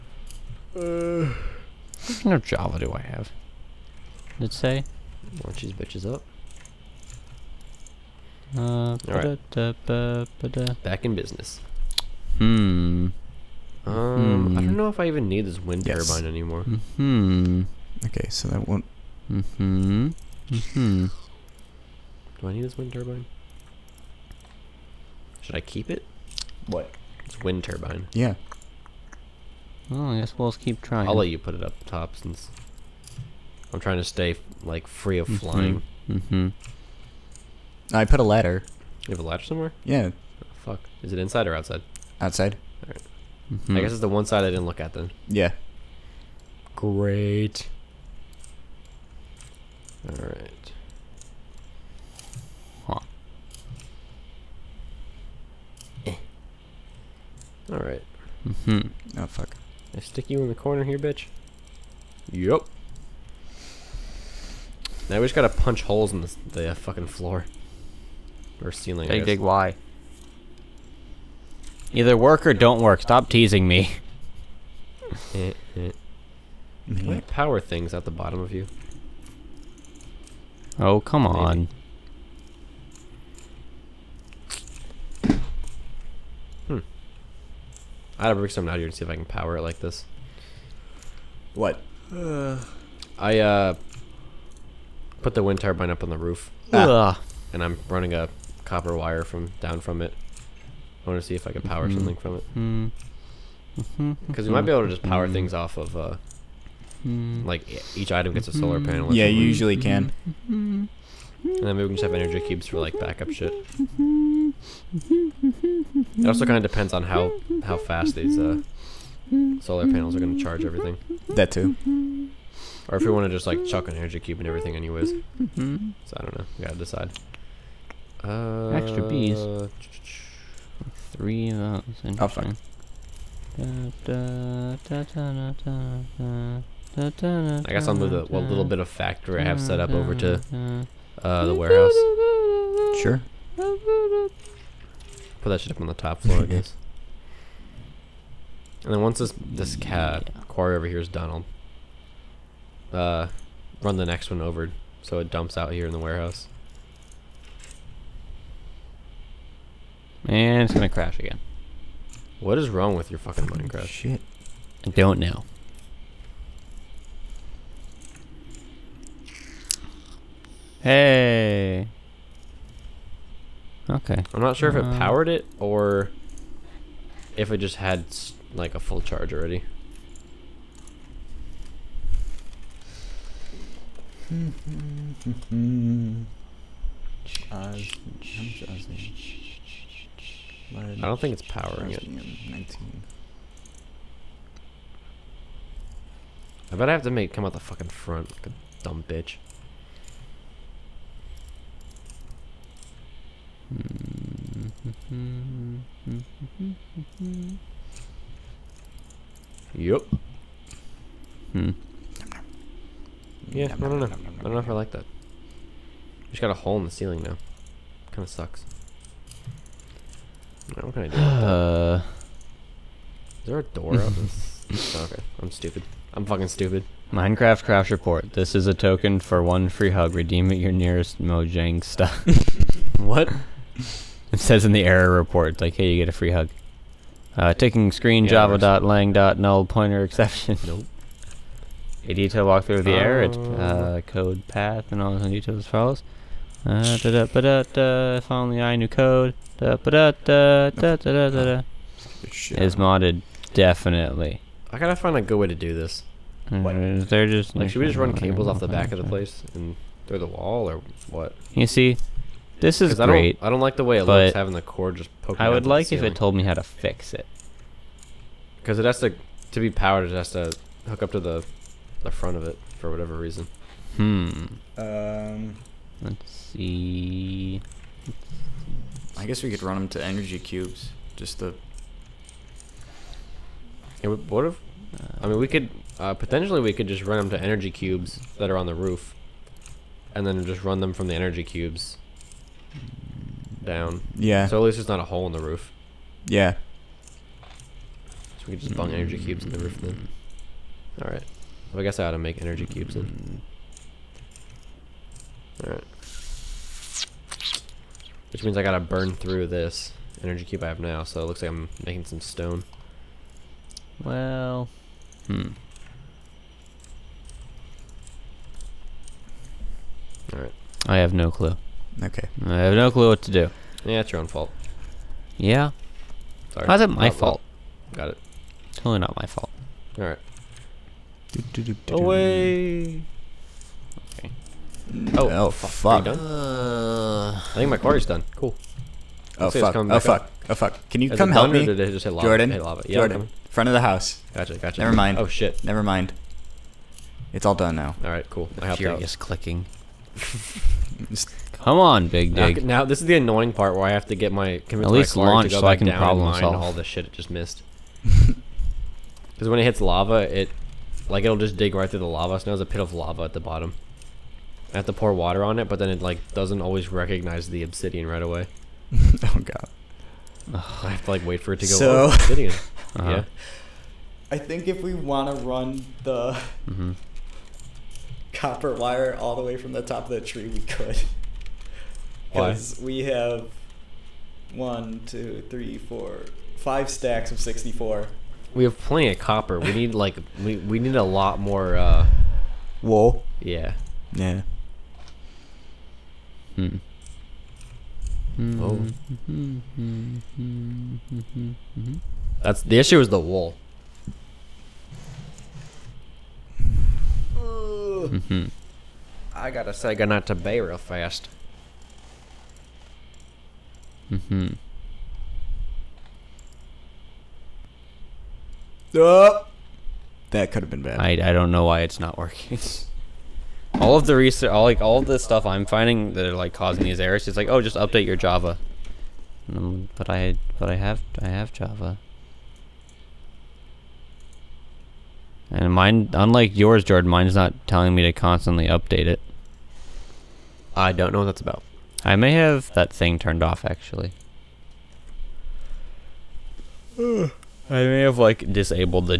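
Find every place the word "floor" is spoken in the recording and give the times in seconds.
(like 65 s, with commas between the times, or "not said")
67 s, 146 s.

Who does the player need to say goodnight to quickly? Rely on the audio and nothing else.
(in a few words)
Bay.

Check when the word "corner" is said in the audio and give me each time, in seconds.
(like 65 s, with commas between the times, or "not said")
60 s.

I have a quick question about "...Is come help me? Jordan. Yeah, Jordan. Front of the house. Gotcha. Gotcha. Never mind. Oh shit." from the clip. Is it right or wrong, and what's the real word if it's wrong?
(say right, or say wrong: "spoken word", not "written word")
right.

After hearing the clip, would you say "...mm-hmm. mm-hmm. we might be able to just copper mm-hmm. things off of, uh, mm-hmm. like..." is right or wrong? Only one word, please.
wrong.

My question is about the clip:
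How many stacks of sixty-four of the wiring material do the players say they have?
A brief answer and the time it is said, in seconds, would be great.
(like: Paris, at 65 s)
5, at 386 s.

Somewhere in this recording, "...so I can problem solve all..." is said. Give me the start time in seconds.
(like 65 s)
355 s.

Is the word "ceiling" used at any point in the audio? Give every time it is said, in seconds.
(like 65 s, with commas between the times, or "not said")
68 s, 216 s.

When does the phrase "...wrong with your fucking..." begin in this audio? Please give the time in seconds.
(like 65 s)
162 s.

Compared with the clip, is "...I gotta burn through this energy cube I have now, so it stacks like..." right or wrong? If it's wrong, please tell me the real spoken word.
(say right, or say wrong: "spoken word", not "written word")
wrong: "looks", not "stacks".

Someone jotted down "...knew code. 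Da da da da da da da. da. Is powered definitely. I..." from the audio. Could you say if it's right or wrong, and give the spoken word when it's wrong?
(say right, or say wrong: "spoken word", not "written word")
wrong: "modded", not "powered".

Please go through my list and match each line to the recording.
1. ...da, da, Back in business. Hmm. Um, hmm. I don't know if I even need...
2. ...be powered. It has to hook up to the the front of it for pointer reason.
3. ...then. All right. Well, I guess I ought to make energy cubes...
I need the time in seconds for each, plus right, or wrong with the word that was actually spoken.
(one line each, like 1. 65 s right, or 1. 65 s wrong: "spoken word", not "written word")
1. 9 s right
2. 269 s wrong: "whatever", not "pointer"
3. 299 s right.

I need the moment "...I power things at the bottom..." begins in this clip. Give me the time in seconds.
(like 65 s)
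77 s.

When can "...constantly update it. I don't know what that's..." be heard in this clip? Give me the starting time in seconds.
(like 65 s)
438 s.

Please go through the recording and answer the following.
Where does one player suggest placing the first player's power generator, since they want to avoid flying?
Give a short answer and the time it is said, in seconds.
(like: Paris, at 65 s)
Up top, at 31 s.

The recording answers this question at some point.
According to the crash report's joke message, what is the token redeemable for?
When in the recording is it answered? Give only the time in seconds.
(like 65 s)
229 s.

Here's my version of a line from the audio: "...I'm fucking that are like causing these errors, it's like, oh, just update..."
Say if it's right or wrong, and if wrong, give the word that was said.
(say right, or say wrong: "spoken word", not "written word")
wrong: "finding", not "fucking".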